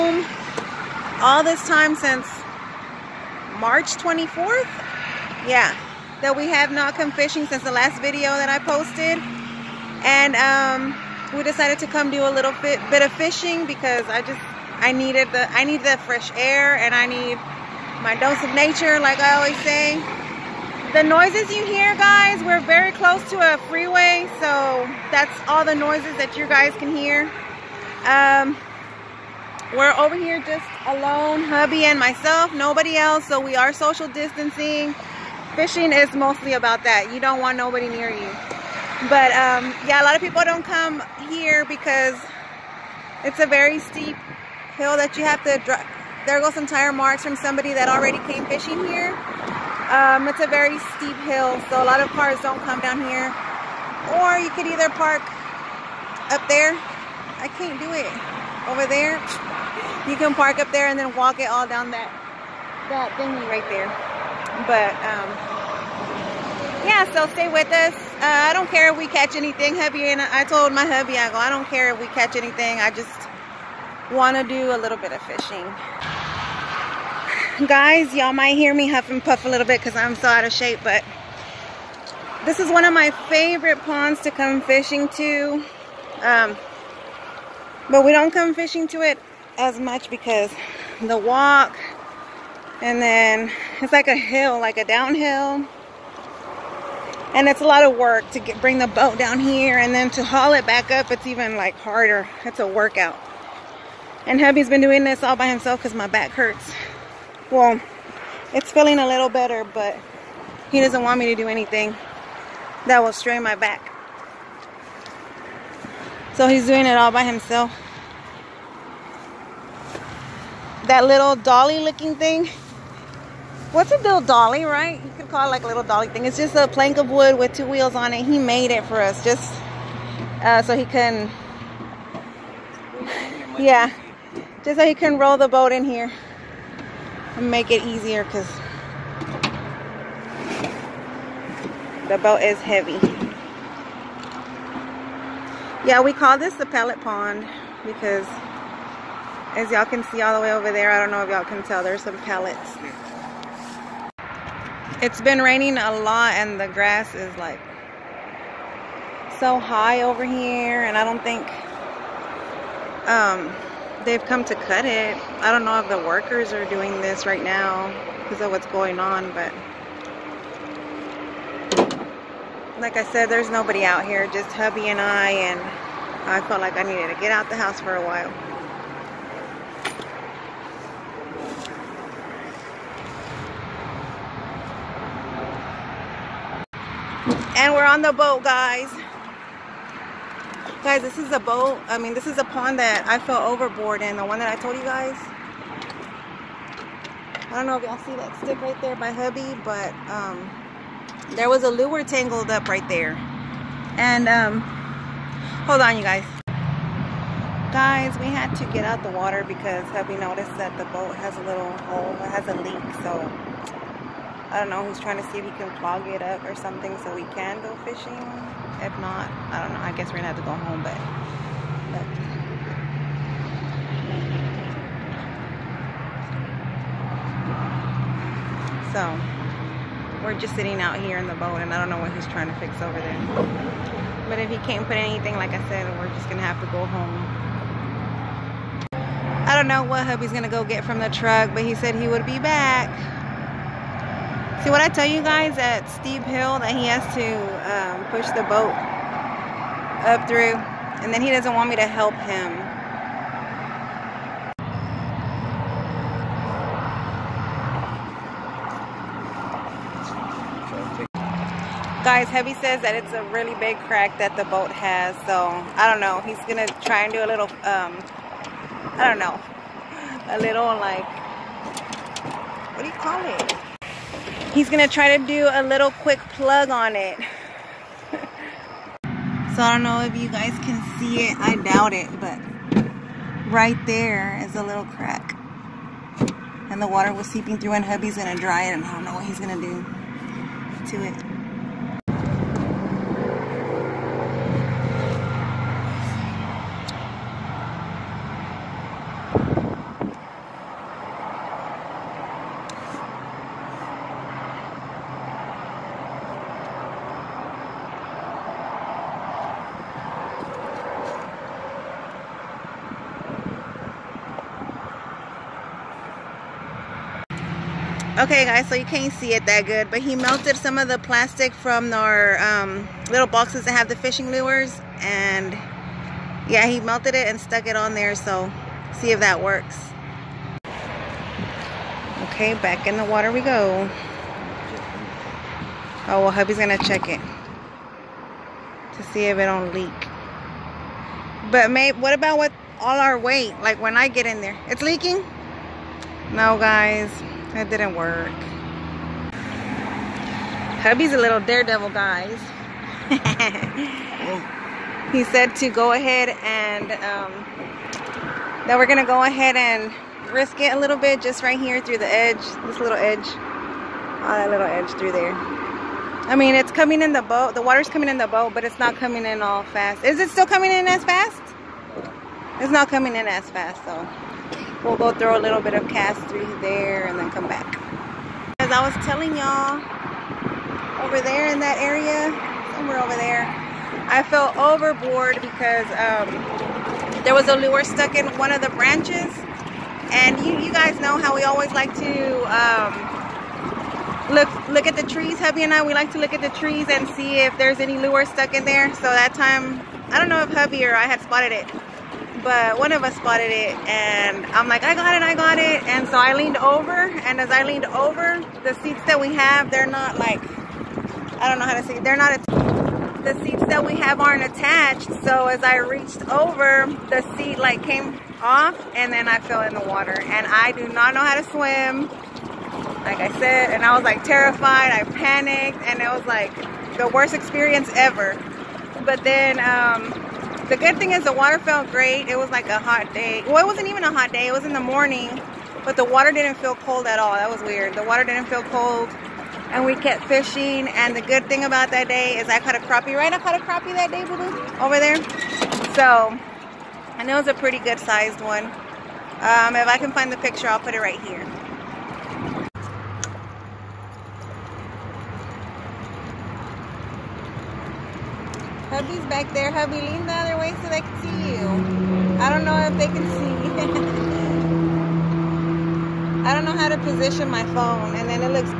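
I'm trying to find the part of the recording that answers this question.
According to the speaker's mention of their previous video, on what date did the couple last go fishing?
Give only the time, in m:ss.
0:03.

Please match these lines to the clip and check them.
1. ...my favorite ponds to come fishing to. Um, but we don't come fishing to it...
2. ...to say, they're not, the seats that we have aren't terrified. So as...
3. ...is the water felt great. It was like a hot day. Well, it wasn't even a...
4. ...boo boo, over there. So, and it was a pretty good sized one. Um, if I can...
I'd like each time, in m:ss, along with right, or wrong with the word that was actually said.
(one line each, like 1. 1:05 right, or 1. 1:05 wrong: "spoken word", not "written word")
1. 1:22 right
2. 6:51 wrong: "attached", not "terrified"
3. 7:11 right
4. 7:24 right.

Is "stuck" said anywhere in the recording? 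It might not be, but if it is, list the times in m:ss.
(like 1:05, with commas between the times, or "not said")
5:27, 6:27, 6:38.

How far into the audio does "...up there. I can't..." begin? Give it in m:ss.
0:56.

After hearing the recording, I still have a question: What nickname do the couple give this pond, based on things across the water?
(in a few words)
The pellet pond.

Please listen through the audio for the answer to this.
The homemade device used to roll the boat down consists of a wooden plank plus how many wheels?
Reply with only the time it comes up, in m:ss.
2:07.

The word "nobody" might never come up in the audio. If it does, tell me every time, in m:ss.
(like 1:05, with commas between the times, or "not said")
0:32, 0:37, 2:53.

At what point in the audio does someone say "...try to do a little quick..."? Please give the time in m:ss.
4:34.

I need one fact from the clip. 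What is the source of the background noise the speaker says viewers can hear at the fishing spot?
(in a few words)
A freeway.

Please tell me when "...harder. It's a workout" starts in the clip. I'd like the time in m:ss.
1:41.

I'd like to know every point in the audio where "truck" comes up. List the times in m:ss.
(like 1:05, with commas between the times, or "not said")
4:01.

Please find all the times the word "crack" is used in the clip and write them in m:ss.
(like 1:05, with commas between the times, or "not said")
4:23, 4:44.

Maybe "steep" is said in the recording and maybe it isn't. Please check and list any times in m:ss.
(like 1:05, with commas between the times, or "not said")
0:43, 0:50, 4:05.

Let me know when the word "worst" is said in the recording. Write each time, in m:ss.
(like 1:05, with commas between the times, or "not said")
7:07.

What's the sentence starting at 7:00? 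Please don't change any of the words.
And I do not know how to swim, like I said.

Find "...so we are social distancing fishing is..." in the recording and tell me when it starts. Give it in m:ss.
0:33.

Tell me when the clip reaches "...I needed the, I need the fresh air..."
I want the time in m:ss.
0:14.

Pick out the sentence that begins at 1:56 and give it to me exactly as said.
So he's doing it all by himself.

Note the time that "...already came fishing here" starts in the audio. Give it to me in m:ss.
0:47.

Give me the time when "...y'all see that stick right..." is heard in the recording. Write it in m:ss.
3:17.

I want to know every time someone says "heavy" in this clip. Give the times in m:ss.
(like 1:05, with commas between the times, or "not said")
2:22, 4:22.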